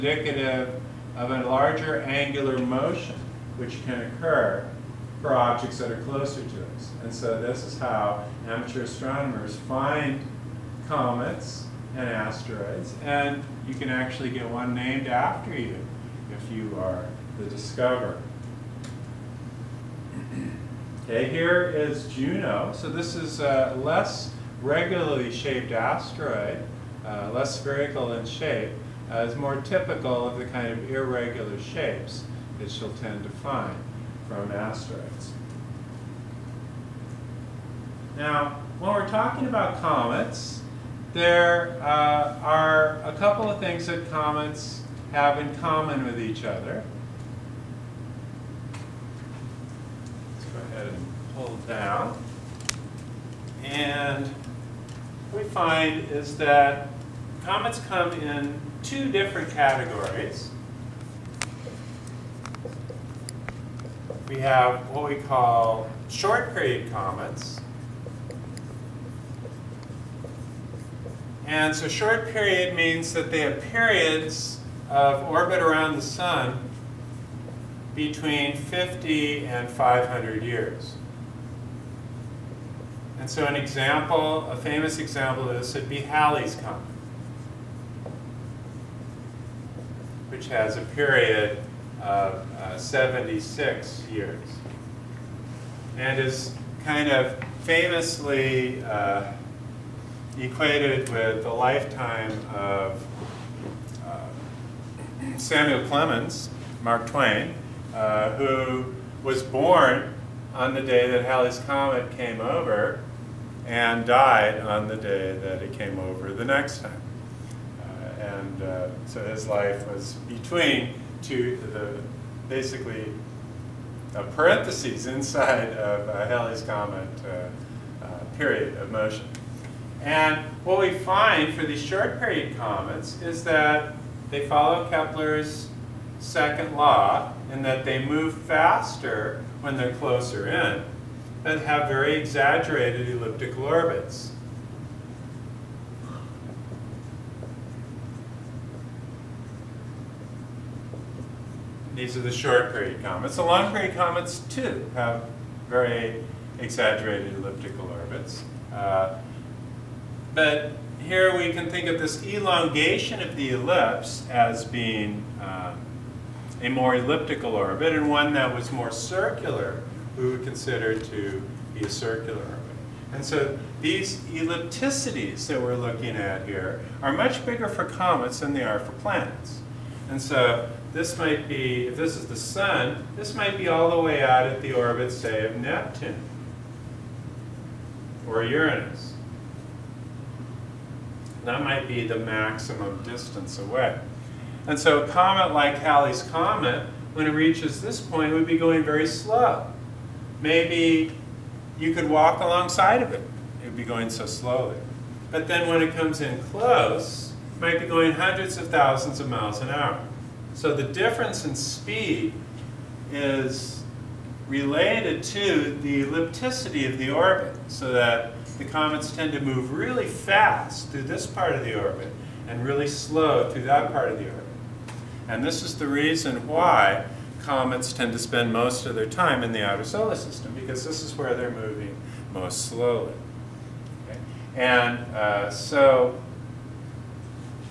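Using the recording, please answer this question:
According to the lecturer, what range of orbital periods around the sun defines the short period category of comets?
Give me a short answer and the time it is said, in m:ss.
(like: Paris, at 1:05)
50 to 500 years, at 1:17.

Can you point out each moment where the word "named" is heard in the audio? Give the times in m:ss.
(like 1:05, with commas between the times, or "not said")
0:14.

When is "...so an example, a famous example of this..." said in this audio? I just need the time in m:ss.
1:23.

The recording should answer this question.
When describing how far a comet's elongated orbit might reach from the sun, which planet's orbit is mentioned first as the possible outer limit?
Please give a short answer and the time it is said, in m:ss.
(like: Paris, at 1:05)
Neptune, at 3:05.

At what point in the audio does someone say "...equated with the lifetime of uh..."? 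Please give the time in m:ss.
1:40.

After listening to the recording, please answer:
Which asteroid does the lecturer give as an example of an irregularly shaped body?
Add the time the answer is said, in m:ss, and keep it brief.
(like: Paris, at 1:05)
Juno, at 0:22.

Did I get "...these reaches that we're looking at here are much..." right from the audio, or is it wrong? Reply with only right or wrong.
wrong.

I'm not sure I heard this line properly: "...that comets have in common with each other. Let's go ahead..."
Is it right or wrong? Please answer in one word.
right.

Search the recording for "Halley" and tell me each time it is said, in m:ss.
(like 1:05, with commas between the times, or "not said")
1:26, 1:51, 2:06, 3:15.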